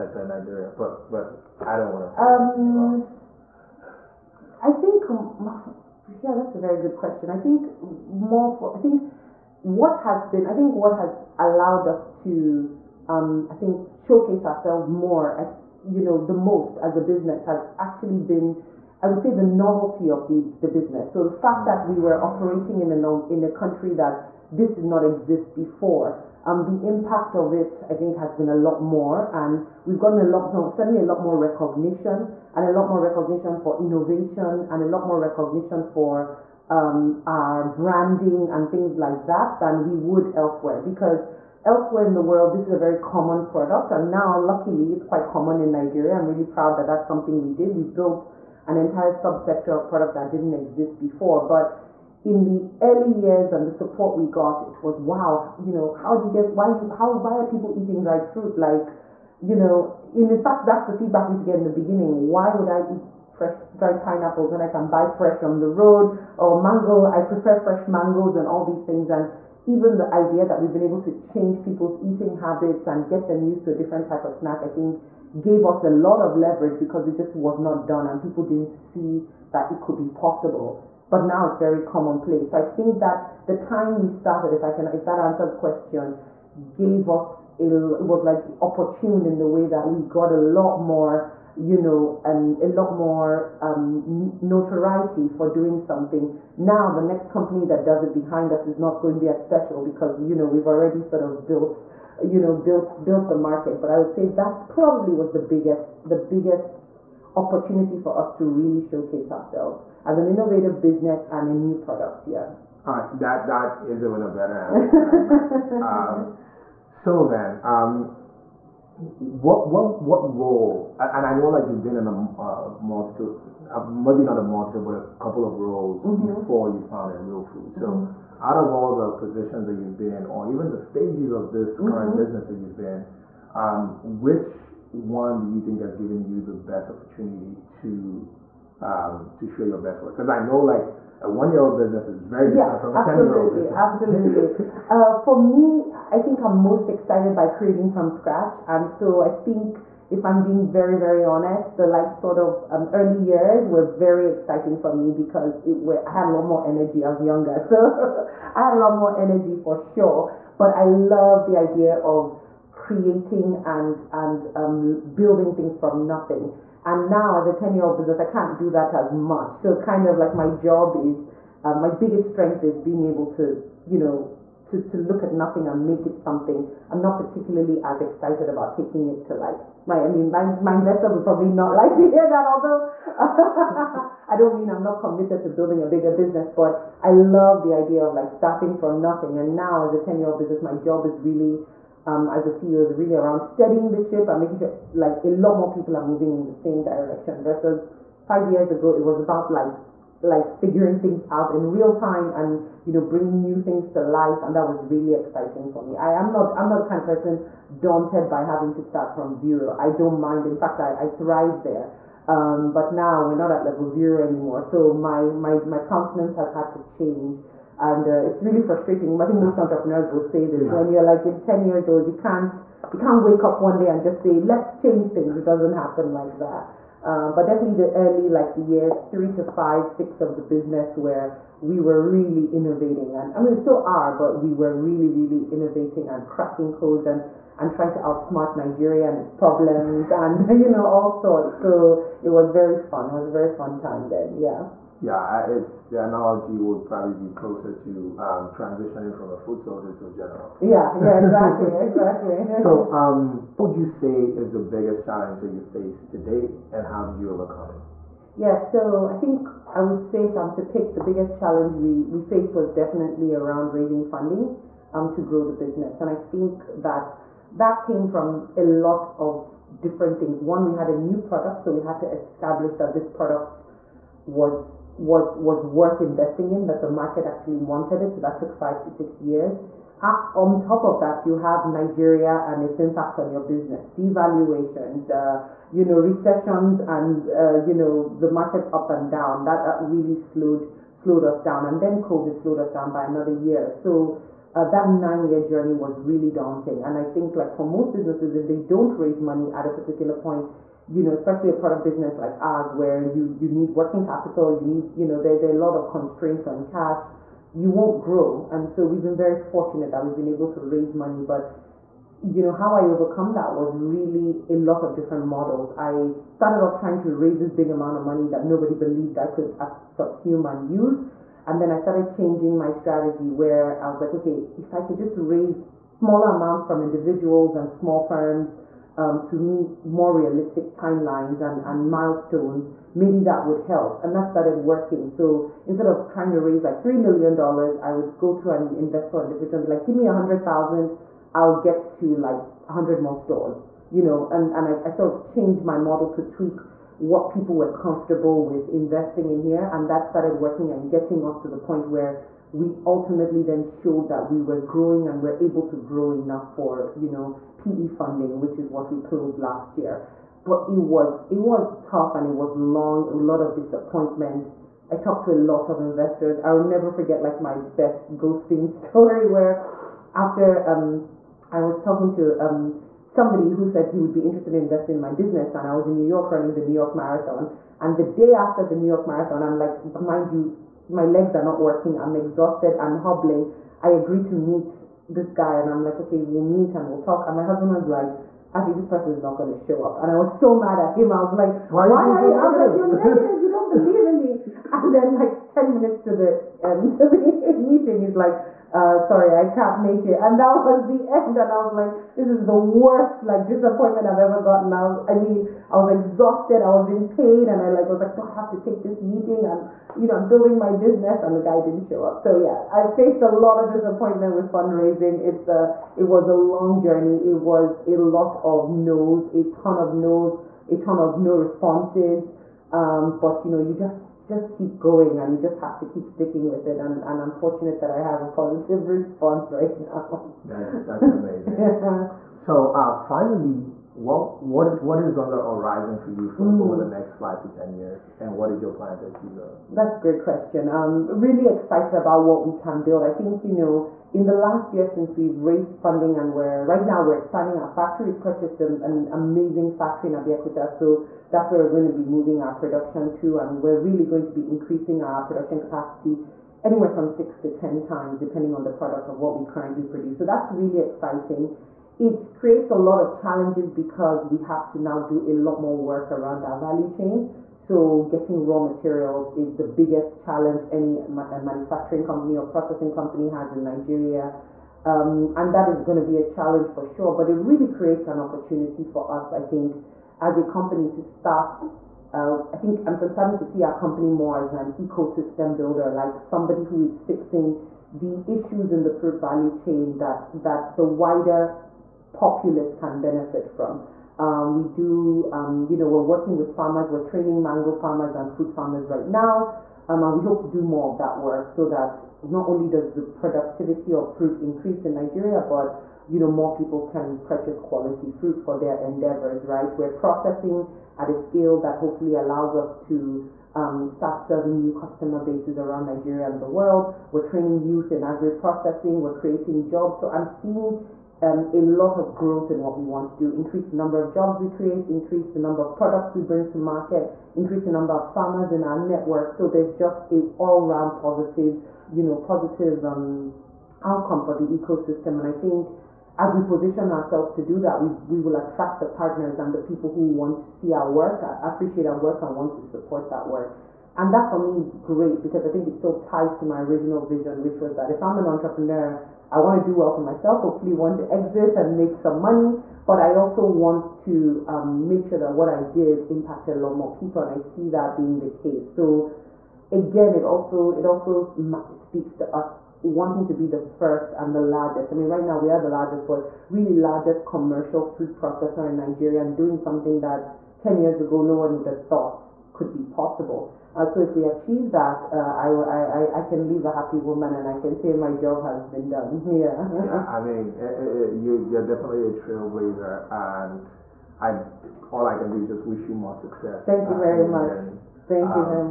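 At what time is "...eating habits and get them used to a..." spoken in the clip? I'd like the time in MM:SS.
01:12.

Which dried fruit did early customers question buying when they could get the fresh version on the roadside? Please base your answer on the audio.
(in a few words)
Pineapples.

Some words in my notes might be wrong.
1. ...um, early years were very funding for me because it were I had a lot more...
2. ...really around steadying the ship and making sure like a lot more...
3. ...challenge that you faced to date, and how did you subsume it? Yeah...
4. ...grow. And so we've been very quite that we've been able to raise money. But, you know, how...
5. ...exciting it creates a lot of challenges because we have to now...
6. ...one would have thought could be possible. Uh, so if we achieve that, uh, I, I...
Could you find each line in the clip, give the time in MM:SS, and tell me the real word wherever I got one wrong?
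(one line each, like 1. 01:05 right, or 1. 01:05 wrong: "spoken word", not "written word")
1. 02:32 wrong: "exciting", not "funding"
2. 03:12 right
3. 04:15 wrong: "overcome", not "subsume"
4. 05:08 wrong: "fortunate", not "quite"
5. 07:40 right
6. 09:31 right.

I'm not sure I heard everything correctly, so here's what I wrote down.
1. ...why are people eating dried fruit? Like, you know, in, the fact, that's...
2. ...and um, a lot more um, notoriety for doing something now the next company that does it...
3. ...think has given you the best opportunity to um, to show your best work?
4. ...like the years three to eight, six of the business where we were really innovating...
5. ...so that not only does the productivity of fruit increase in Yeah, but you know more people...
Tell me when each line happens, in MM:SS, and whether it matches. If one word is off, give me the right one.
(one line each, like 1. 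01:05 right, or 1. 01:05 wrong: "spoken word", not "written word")
1. 00:57 right
2. 01:32 right
3. 02:15 right
4. 03:48 wrong: "five", not "eight"
5. 08:21 wrong: "Nigeria", not "Yeah".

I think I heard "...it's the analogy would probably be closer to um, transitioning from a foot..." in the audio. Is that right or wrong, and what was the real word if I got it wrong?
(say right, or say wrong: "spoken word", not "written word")
right.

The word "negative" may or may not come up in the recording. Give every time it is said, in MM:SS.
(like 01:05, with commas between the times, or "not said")
06:32.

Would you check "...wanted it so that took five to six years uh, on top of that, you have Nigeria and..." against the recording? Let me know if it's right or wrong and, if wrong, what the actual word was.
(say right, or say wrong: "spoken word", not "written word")
right.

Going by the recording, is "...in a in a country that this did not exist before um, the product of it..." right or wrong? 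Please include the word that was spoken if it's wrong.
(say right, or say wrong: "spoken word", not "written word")
wrong: "impact", not "product".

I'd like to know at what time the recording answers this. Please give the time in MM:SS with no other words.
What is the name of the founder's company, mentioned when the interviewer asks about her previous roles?
02:07.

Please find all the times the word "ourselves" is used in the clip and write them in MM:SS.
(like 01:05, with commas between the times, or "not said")
00:14, 01:49, 08:56.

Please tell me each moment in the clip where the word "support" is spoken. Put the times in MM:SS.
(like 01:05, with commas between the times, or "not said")
00:53, 09:02.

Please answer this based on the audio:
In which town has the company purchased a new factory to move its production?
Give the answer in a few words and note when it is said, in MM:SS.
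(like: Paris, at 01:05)
Abeokuta, at 07:30.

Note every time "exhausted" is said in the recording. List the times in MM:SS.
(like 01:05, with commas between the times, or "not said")
06:22, 06:45.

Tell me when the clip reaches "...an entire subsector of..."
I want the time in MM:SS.
00:48.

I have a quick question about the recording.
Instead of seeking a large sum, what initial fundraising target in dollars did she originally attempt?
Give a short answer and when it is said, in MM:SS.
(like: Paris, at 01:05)
$3 million, at 05:36.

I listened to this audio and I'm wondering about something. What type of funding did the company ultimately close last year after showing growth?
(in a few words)
PE funding.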